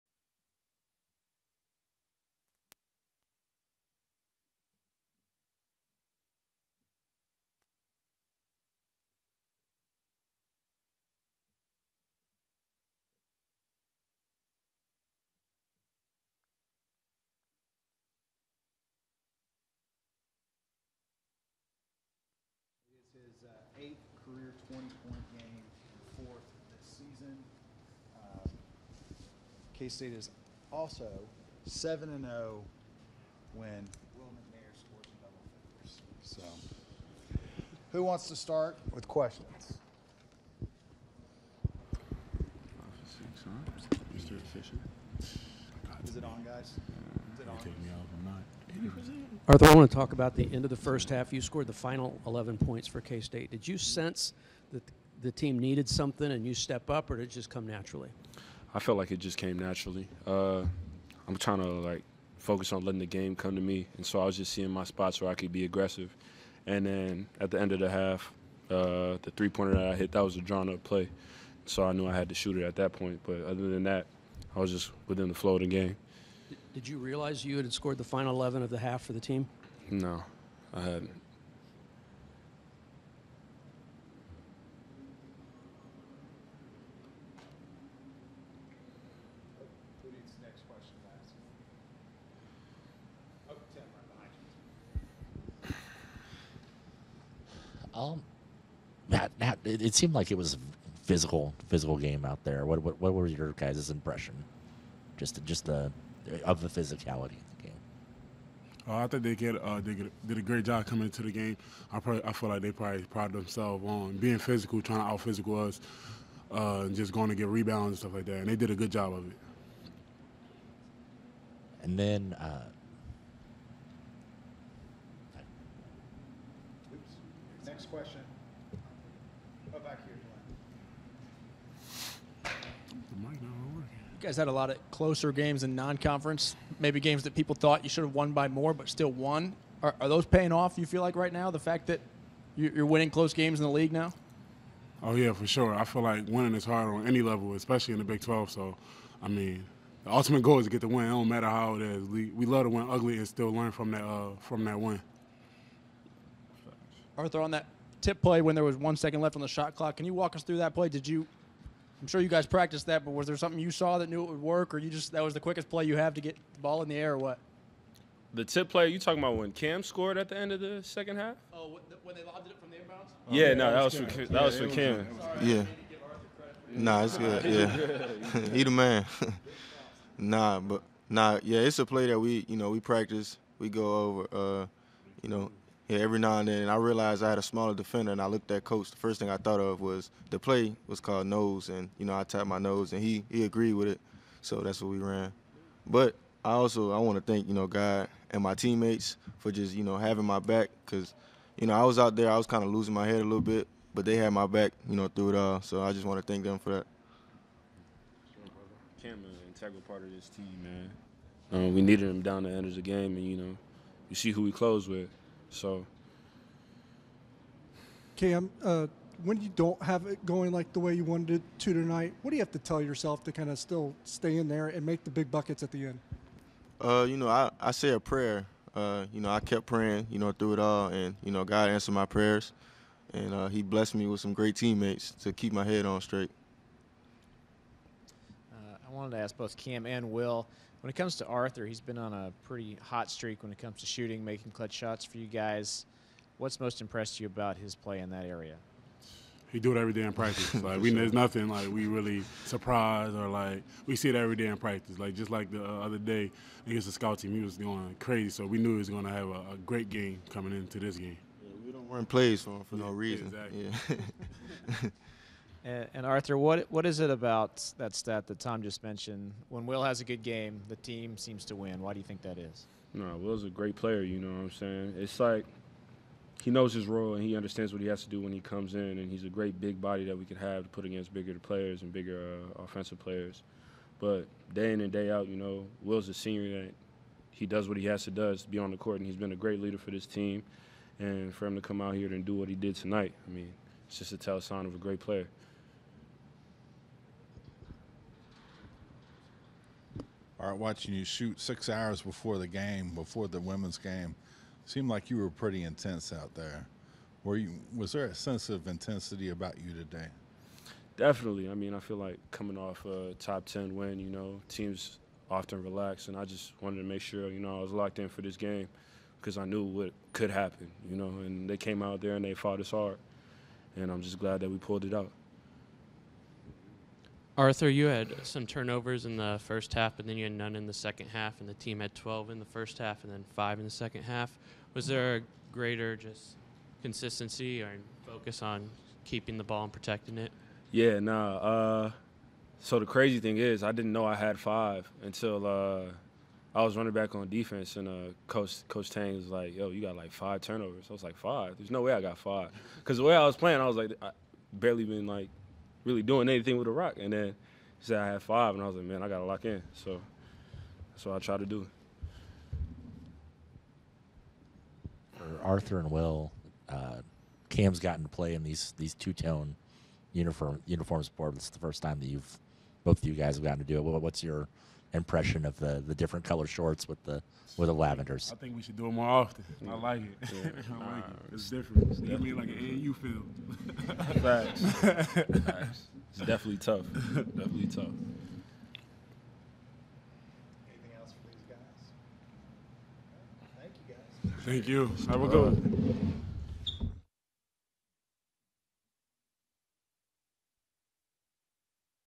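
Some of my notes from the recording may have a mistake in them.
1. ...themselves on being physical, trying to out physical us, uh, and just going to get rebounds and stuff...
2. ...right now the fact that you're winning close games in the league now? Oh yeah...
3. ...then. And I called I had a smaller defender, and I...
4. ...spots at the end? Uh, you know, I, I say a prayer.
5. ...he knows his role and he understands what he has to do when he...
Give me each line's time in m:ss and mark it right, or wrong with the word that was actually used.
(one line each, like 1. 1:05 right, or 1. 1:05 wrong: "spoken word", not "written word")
1. 1:53 right
2. 2:21 right
3. 3:06 wrong: "realized", not "called"
4. 3:45 wrong: "buckets", not "spots"
5. 4:36 right.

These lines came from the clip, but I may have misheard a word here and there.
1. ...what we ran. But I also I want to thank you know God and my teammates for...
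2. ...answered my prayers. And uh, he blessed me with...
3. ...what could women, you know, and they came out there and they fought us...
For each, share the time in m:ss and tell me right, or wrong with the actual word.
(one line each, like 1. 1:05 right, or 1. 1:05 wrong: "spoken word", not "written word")
1. 3:14 right
2. 3:51 right
3. 5:19 wrong: "happen", not "women".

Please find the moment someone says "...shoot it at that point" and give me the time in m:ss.
1:12.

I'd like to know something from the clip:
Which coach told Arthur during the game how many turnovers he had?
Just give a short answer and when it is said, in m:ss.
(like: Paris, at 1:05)
Coach Tang, at 5:48.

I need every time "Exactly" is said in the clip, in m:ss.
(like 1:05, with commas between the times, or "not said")
4:23.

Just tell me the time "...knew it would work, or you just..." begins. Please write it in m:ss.
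2:44.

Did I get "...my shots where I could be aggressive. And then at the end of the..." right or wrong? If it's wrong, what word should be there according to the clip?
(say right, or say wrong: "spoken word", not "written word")
wrong: "spots", not "shots".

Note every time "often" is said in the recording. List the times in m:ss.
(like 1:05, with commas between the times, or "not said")
5:15, 6:19.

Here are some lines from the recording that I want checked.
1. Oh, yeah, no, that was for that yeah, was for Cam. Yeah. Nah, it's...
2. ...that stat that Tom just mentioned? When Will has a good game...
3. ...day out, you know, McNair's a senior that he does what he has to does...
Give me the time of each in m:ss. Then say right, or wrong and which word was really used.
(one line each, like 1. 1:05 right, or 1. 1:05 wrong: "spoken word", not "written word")
1. 2:53 right
2. 4:27 right
3. 4:44 wrong: "Will", not "McNair".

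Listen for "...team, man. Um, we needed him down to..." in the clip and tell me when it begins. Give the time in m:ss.
3:30.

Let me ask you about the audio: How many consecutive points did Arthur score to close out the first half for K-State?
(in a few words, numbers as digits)
11.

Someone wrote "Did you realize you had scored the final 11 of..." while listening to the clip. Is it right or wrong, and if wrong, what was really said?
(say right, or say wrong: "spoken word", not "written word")
right.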